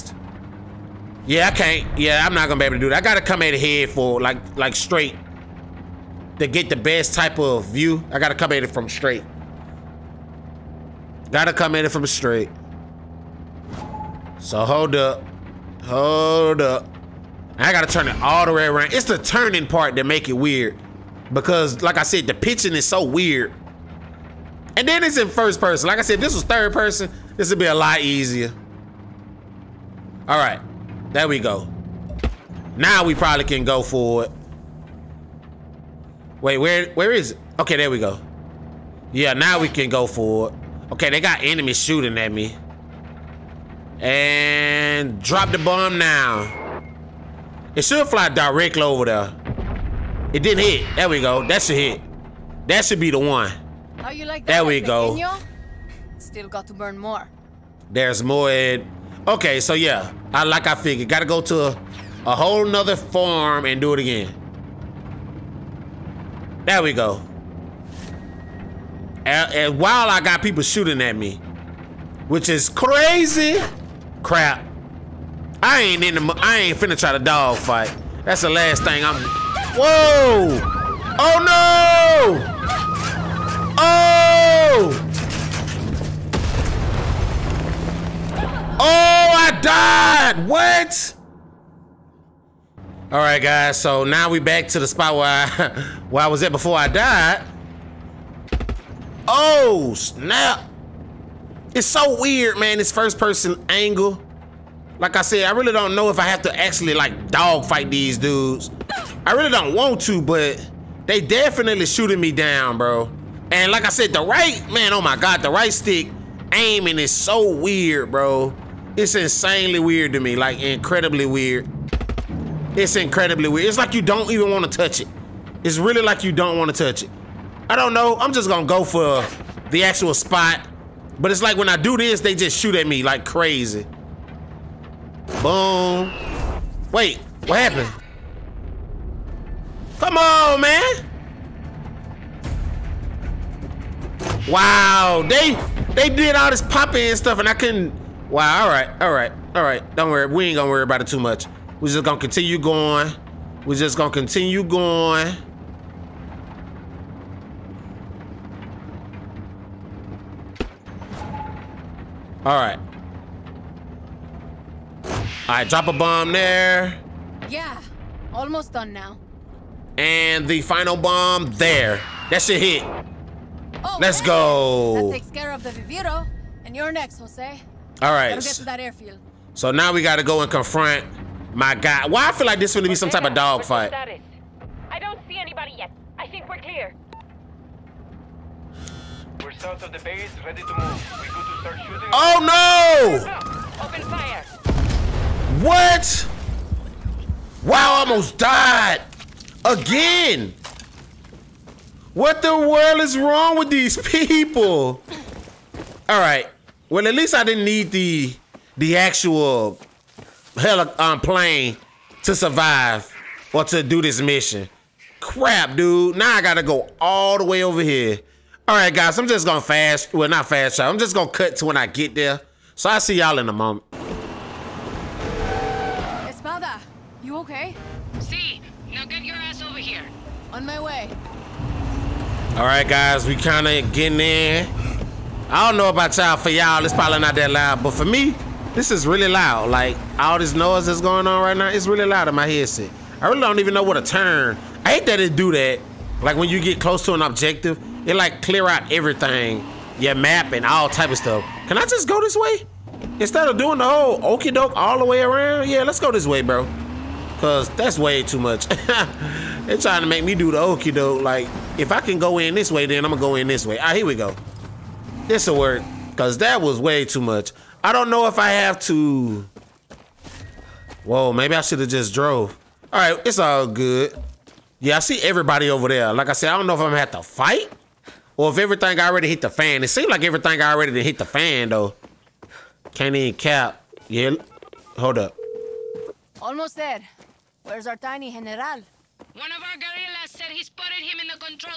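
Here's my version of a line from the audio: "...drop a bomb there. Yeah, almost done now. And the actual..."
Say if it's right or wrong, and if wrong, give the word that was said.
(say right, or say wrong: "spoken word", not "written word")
wrong: "final", not "actual".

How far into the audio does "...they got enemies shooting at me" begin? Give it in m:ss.
0:41.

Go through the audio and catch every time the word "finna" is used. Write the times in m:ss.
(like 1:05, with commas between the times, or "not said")
1:16.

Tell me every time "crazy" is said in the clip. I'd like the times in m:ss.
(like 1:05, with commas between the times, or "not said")
1:12, 2:13.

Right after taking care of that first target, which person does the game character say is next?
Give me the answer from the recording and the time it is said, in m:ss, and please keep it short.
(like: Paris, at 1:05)
Jose, at 2:57.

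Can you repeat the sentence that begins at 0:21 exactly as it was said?
Because like I said, the pitching is so weird.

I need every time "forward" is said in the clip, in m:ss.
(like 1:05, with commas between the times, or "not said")
0:33, 0:40.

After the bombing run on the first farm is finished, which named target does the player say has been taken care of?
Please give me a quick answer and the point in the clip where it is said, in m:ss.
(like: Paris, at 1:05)
Viviro, at 2:55.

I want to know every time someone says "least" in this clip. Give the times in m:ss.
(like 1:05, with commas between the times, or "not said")
3:27.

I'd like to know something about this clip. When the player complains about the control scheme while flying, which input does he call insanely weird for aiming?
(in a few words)
right stick.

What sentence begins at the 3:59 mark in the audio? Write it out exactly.
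Like all this noise that's going on right now, it's really loud in my headset.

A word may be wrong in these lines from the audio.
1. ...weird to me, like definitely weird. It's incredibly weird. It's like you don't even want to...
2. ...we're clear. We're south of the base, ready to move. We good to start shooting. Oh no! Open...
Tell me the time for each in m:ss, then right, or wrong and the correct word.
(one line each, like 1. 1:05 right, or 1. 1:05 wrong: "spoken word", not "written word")
1. 1:59 wrong: "incredibly", not "definitely"
2. 3:06 right.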